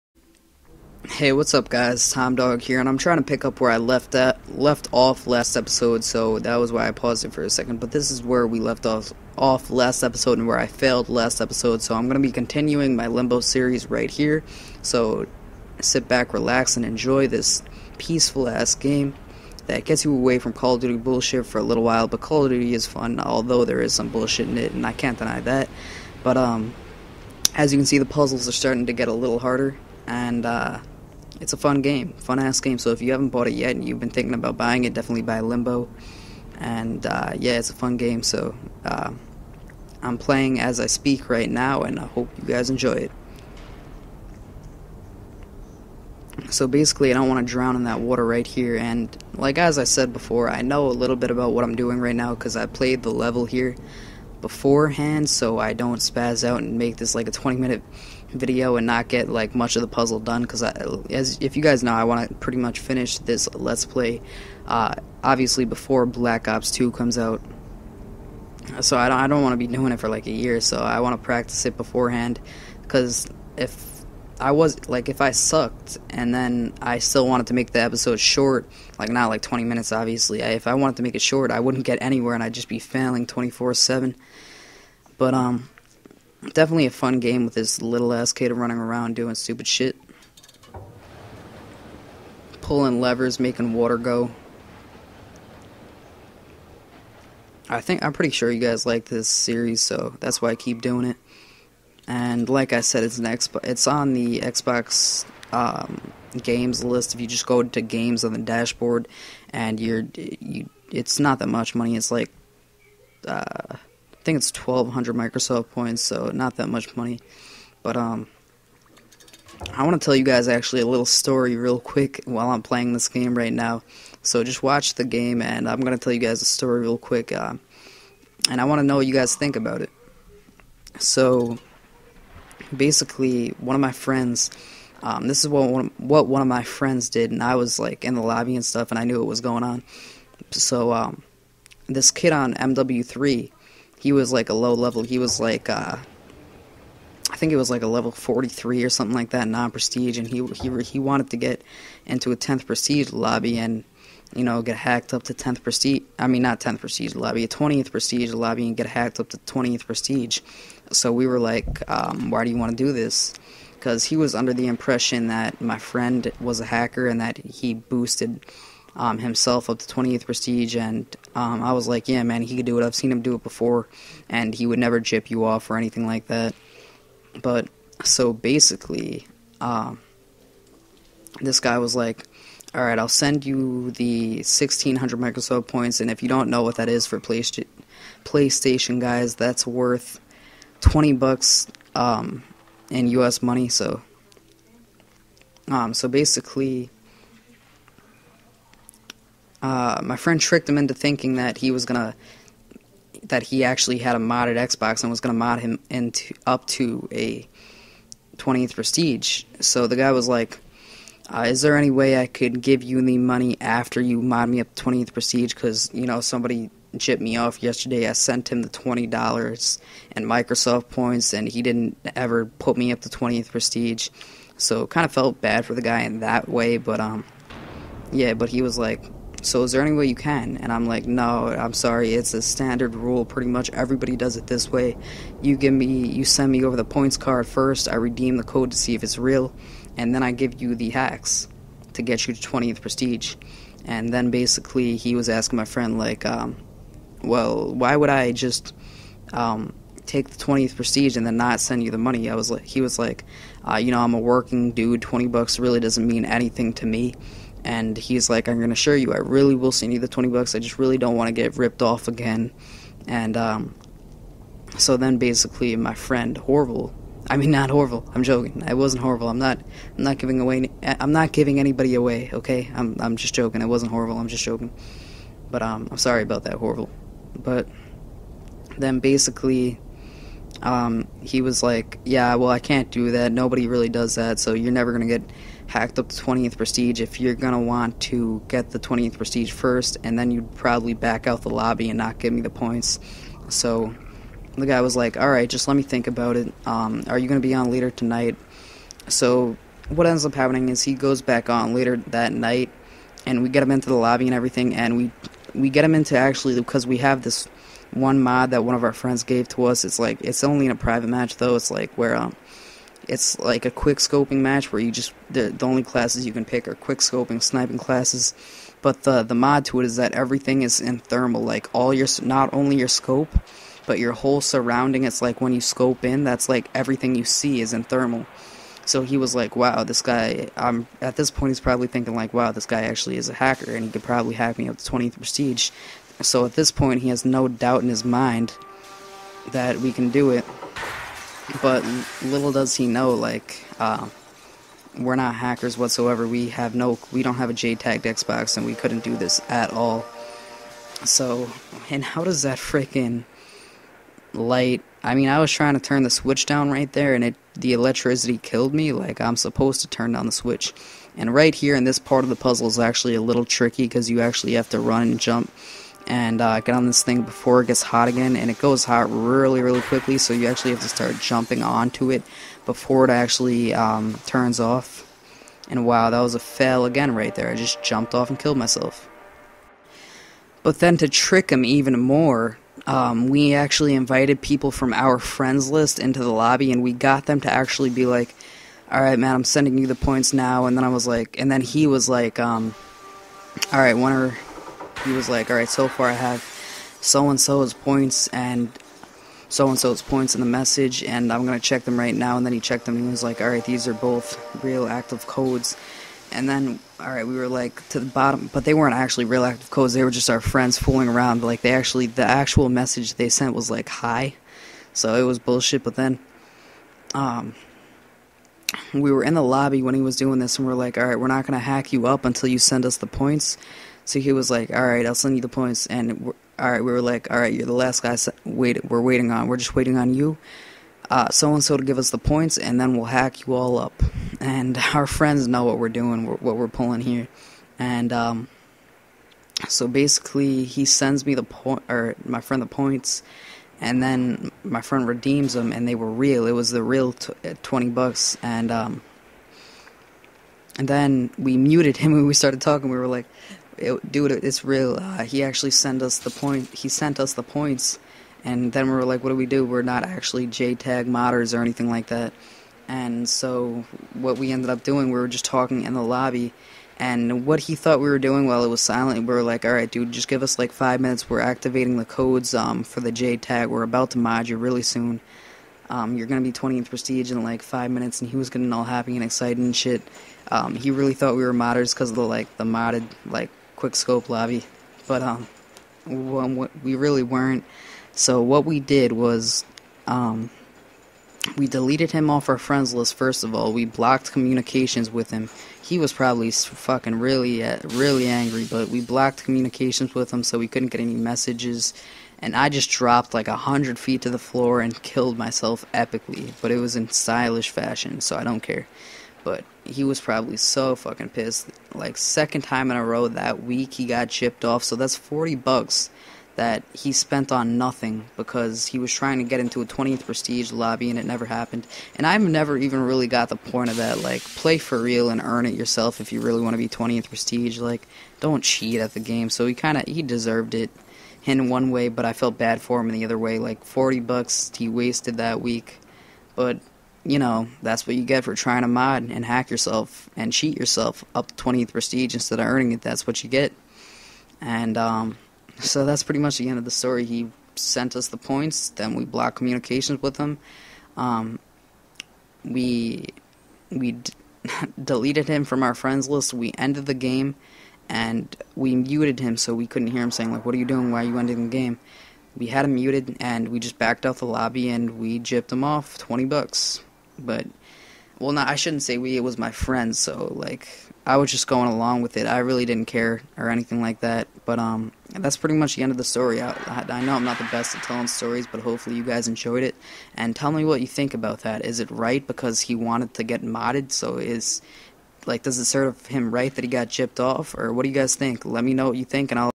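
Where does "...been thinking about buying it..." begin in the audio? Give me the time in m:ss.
0:33.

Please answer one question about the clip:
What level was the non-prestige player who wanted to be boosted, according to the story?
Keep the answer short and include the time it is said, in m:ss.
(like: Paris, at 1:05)
43, at 2:27.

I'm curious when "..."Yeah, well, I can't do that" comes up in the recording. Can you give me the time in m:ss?
4:42.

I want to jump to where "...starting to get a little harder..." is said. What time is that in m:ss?
0:28.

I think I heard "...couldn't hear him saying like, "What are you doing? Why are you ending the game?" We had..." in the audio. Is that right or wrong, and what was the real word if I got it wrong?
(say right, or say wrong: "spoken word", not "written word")
right.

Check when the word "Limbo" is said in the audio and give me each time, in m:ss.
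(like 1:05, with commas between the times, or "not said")
0:13, 0:35.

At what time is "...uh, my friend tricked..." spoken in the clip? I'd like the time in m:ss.
3:19.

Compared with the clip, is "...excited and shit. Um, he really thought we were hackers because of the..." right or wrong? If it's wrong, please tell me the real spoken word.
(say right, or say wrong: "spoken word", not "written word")
wrong: "modders", not "hackers".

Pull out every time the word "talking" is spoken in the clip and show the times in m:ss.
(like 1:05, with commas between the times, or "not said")
7:32, 7:45.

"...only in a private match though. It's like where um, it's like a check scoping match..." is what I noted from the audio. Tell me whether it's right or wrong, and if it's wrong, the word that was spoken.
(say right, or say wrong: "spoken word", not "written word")
wrong: "quick", not "check".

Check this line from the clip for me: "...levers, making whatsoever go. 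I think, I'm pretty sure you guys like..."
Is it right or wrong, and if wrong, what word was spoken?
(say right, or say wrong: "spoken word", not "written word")
wrong: "water", not "whatsoever".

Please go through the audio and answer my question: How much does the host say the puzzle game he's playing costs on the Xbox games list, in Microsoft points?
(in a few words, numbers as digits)
1200 Microsoft points.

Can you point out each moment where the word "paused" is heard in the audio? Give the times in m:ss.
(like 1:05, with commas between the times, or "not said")
0:06.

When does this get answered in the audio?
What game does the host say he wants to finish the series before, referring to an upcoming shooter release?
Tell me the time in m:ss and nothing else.
1:06.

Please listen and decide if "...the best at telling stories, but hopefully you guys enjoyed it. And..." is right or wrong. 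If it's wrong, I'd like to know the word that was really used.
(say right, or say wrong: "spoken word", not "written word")
right.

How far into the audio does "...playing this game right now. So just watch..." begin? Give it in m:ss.
2:02.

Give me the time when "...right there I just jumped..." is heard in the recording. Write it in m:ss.
6:17.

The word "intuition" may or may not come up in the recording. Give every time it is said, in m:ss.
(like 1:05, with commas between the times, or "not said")
not said.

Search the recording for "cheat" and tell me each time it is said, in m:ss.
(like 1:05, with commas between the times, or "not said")
8:48, 9:00.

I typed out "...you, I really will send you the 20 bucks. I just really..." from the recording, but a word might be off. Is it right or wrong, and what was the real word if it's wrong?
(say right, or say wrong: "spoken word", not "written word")
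right.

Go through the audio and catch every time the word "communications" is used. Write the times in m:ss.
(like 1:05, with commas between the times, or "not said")
8:14, 8:19, 9:09.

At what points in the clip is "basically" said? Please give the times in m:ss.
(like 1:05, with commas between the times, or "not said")
0:46, 2:12, 2:58, 3:16, 4:04, 4:25, 4:38, 7:19.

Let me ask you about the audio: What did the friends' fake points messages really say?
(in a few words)
hi.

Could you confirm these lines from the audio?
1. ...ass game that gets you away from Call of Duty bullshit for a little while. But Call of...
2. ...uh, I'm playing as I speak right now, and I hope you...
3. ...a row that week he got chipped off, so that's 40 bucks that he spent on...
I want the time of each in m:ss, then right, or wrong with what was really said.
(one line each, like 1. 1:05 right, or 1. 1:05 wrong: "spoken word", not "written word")
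1. 0:18 right
2. 0:38 right
3. 8:32 right.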